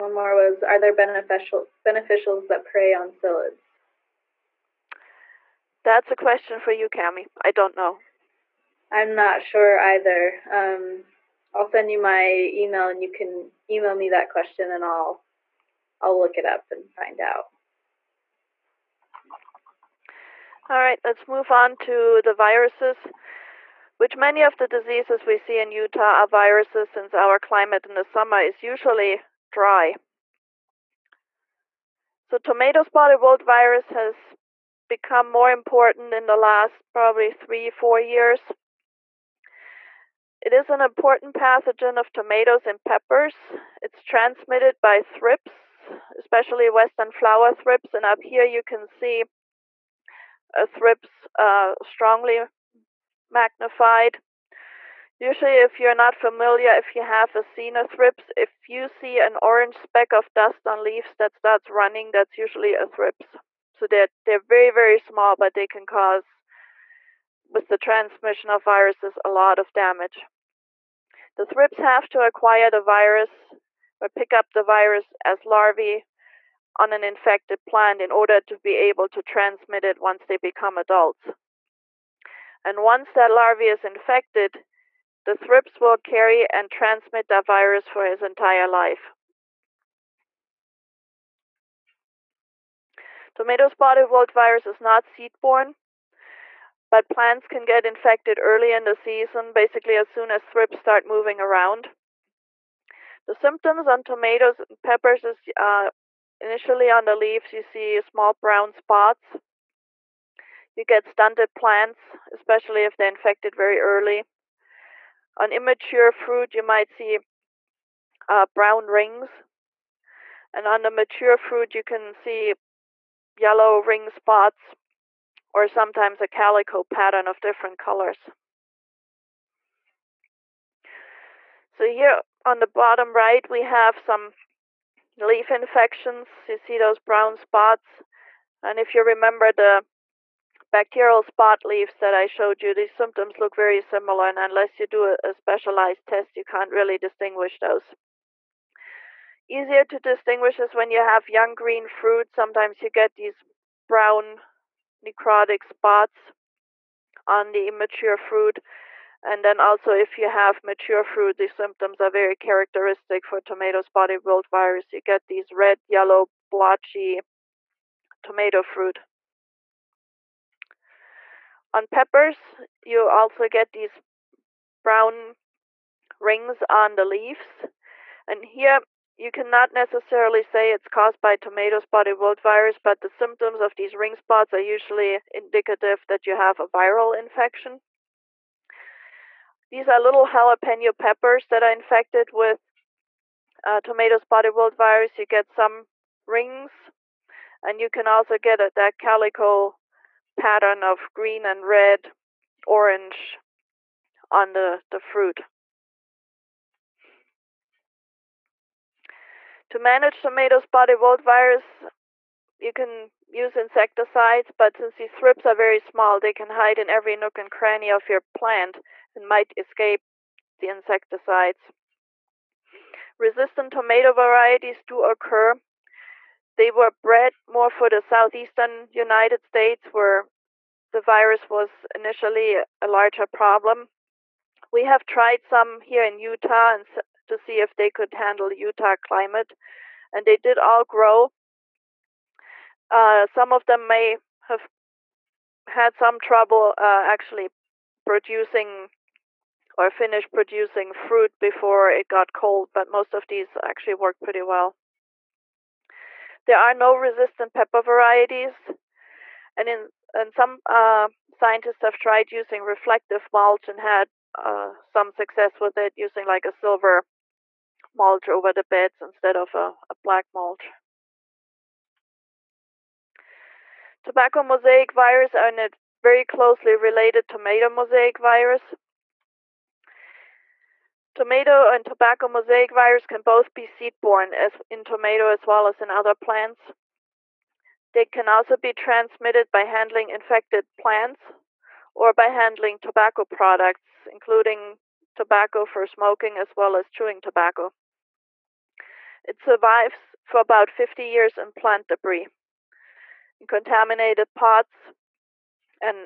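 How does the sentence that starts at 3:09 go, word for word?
These are little jalapeno peppers that are infected with uh, tomato spotted wilt virus.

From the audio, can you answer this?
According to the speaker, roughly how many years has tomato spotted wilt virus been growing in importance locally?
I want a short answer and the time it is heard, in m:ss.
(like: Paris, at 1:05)
3, 4 years, at 0:37.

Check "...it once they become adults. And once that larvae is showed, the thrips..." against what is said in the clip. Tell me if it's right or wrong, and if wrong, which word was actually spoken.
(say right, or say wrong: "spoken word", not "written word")
wrong: "infected", not "showed".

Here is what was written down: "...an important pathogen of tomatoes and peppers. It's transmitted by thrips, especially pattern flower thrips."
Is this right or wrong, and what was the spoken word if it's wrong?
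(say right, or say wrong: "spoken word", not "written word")
wrong: "western", not "pattern".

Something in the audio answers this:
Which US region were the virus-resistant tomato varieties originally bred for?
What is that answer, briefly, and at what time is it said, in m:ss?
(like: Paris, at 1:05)
southeastern United States, at 3:48.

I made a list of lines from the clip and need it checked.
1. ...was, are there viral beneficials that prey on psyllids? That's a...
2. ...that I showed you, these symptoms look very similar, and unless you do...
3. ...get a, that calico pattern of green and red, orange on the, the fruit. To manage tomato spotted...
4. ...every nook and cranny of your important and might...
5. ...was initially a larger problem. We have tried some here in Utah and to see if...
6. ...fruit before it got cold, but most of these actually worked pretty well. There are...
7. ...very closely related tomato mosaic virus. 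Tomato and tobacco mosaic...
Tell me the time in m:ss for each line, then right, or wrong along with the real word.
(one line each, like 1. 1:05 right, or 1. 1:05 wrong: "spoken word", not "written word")
1. 0:00 wrong: "beneficial", not "viral"
2. 2:21 right
3. 3:18 right
4. 3:36 wrong: "plant", not "important"
5. 3:51 right
6. 4:10 right
7. 4:36 right.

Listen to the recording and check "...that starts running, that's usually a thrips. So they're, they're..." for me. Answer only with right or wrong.
right.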